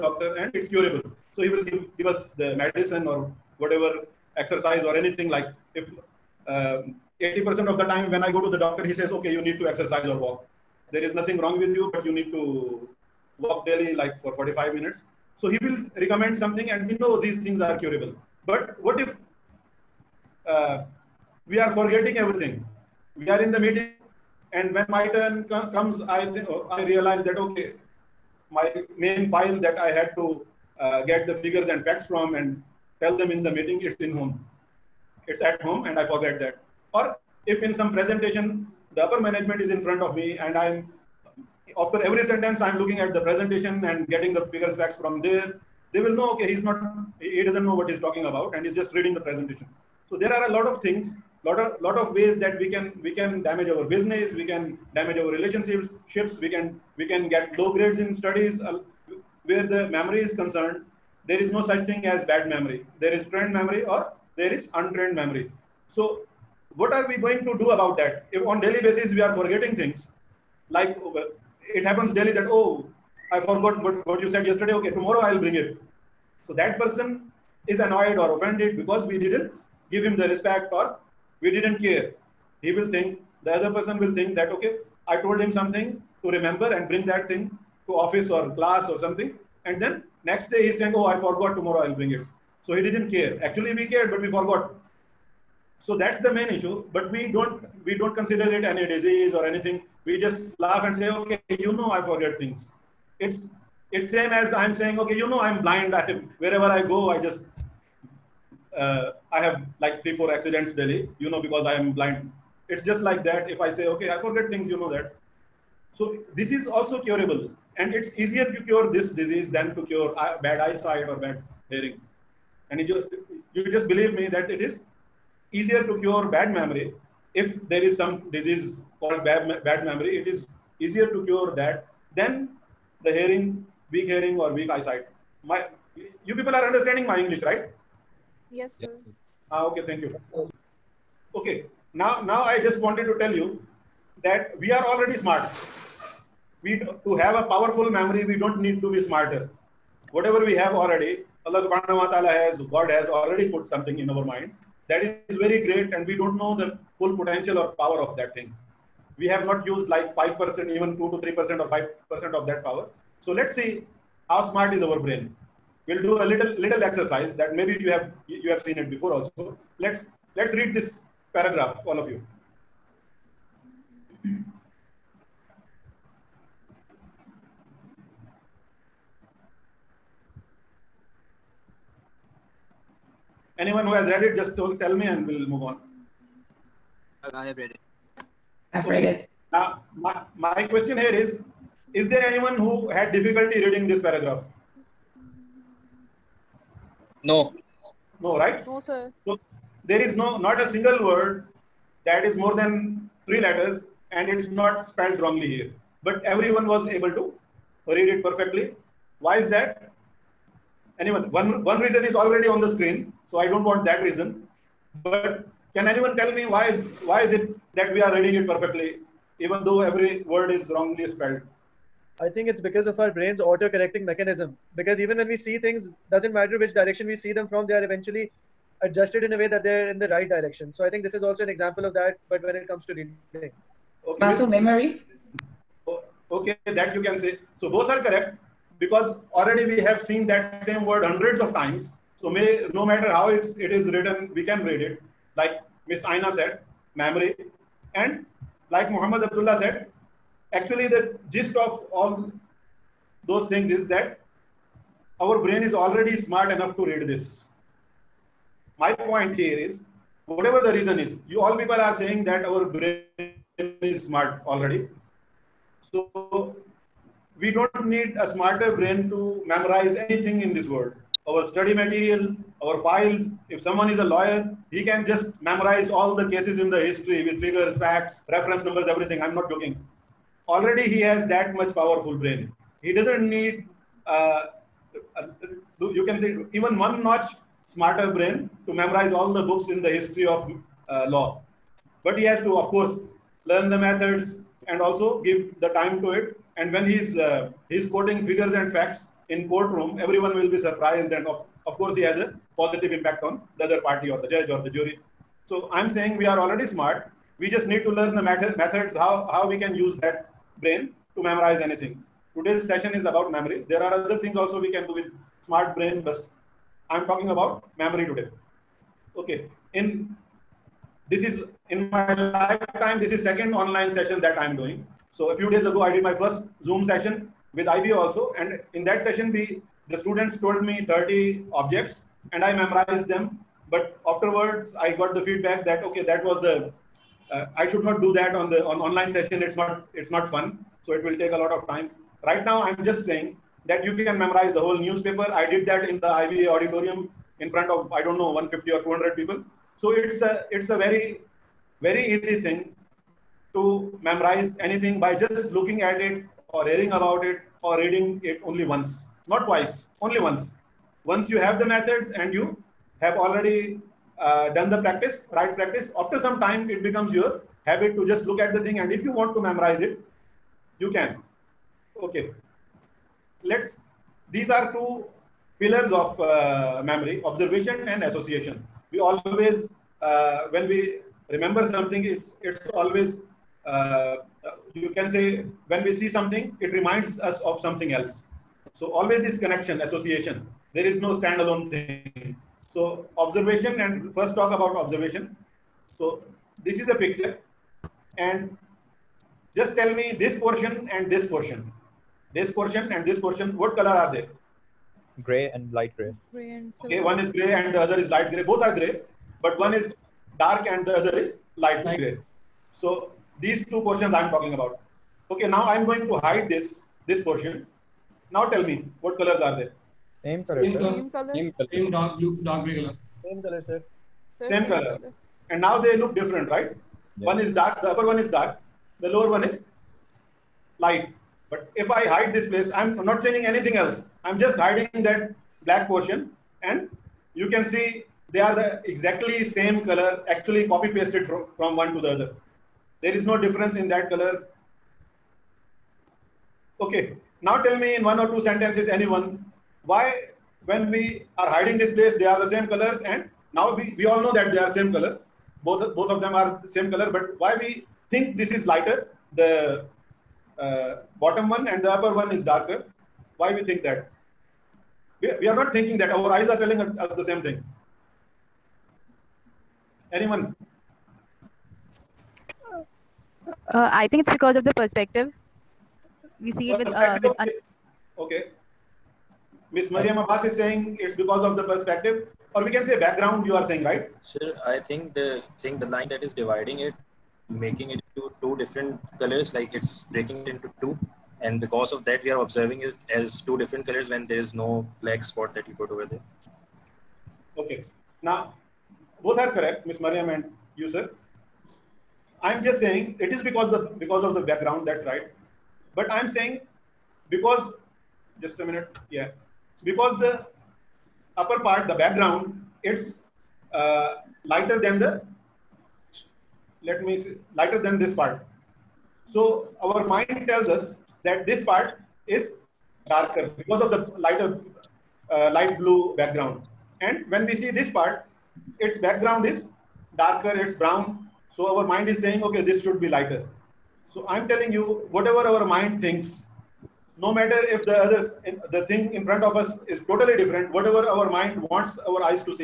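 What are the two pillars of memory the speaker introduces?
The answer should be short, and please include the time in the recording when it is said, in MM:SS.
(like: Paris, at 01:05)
Observation and association, at 06:17.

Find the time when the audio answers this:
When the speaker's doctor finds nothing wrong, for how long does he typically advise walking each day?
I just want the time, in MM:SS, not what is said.
00:14.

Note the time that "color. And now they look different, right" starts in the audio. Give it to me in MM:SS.
07:04.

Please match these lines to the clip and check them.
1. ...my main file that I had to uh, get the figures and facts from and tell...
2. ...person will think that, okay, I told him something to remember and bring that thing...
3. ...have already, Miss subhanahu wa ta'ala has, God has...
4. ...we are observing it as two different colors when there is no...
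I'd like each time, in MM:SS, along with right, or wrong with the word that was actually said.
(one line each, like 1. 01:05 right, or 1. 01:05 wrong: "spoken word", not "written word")
1. 00:28 right
2. 01:23 right
3. 02:30 wrong: "Allah", not "Miss"
4. 08:12 right.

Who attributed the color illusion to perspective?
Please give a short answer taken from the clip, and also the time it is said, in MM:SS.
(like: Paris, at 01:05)
Mariam Abbas, at 07:59.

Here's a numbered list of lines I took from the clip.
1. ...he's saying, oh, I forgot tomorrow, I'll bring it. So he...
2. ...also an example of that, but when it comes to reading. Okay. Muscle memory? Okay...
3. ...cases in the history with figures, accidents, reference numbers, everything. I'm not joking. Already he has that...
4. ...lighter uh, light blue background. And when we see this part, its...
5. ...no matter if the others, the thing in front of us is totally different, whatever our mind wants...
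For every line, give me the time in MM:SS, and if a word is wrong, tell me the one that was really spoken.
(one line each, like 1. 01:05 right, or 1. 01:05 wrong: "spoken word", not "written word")
1. 01:30 right
2. 03:51 right
3. 04:36 wrong: "facts", not "accidents"
4. 08:44 right
5. 08:57 right.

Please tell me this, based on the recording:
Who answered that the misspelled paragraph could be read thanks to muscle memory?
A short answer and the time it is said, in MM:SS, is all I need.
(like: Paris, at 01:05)
Muhammad Abdullah, at 04:08.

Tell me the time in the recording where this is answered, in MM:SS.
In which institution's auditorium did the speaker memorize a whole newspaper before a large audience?
05:46.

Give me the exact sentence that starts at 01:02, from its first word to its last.
There is trend memory or there is untrained memory.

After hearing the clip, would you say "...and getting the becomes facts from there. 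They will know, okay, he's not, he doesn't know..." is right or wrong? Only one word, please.
wrong.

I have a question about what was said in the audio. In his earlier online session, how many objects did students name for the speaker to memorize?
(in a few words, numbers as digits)
30.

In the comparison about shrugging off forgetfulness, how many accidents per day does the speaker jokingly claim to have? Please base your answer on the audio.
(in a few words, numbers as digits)
3 or 4.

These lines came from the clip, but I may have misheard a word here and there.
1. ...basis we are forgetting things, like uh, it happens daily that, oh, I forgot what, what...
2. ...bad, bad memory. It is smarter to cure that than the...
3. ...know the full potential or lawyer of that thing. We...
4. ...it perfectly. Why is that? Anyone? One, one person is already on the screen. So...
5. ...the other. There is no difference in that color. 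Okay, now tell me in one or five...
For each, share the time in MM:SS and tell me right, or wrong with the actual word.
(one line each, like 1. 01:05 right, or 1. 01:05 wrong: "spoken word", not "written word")
1. 01:08 right
2. 02:09 wrong: "easier", not "smarter"
3. 02:36 wrong: "power", not "lawyer"
4. 03:28 wrong: "reason", not "person"
5. 07:21 wrong: "two", not "five".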